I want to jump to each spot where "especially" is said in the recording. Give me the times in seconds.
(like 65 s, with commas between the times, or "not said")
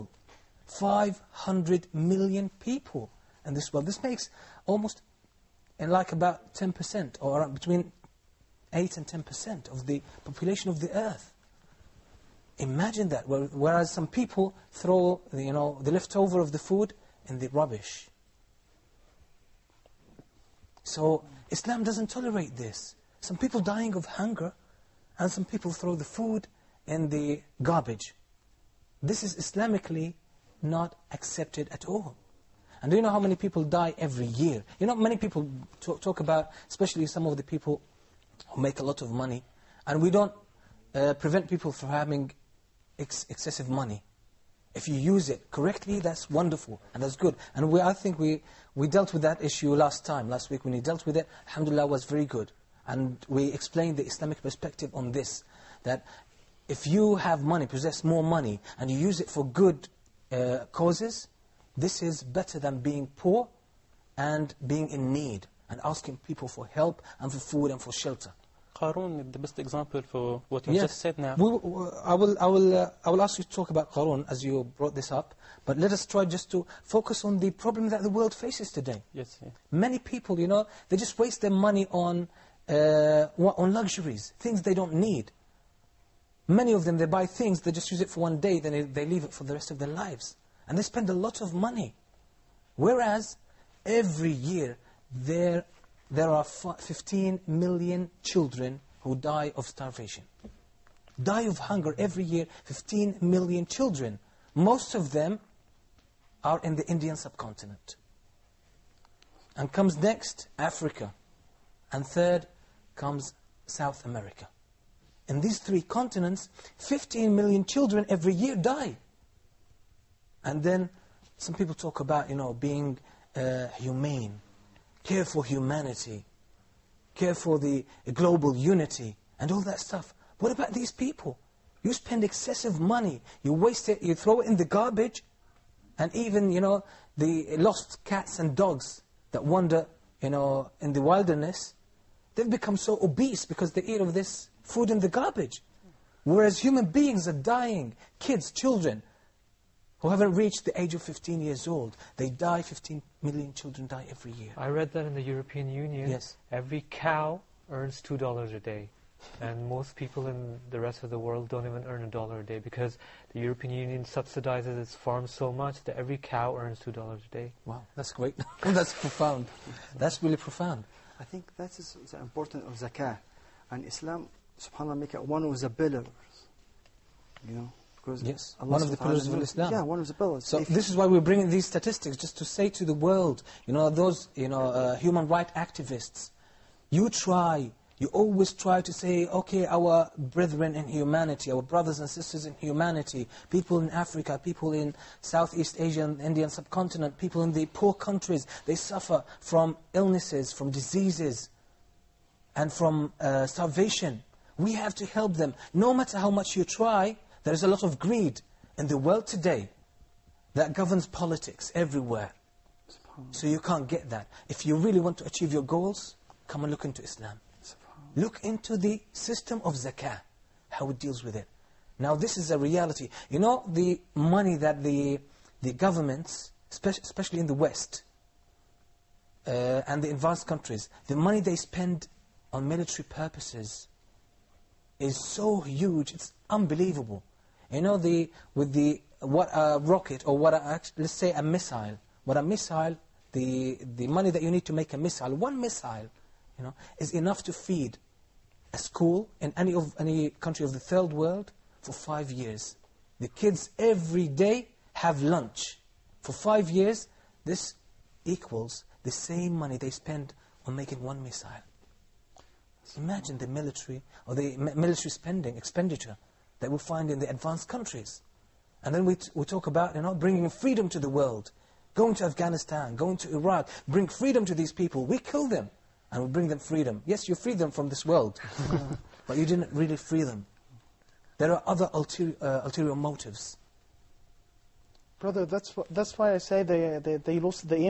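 36 s, 226 s.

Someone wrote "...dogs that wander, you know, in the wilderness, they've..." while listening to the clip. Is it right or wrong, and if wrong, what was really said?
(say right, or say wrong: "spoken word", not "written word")
right.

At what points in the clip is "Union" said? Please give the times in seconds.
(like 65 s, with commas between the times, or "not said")
155 s, 163 s.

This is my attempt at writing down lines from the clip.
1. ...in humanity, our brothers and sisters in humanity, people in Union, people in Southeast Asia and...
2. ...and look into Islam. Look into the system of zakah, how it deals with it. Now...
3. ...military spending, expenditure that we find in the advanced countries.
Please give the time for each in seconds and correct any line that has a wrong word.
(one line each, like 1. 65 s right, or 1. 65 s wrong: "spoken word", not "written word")
1. 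190 s wrong: "Africa", not "Union"
2. 216 s right
3. 264 s right.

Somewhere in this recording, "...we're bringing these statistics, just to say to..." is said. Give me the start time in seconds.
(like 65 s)
181 s.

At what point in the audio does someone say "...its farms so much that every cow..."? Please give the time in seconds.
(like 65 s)
164 s.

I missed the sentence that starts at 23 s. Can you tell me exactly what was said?
Some people dying of hunger and some people throw the food in the garbage.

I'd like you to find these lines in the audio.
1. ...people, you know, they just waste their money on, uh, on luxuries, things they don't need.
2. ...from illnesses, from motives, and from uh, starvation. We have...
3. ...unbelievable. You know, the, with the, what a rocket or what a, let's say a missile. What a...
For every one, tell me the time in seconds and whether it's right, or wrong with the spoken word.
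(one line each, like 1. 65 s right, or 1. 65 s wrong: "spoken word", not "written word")
1. 79 s right
2. 199 s wrong: "diseases", not "motives"
3. 236 s right.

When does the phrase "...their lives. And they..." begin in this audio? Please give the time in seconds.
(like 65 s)
89 s.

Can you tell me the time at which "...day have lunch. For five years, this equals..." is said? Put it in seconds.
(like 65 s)
254 s.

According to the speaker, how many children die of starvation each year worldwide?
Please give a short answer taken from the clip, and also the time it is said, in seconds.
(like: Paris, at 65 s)
15 million, at 96 s.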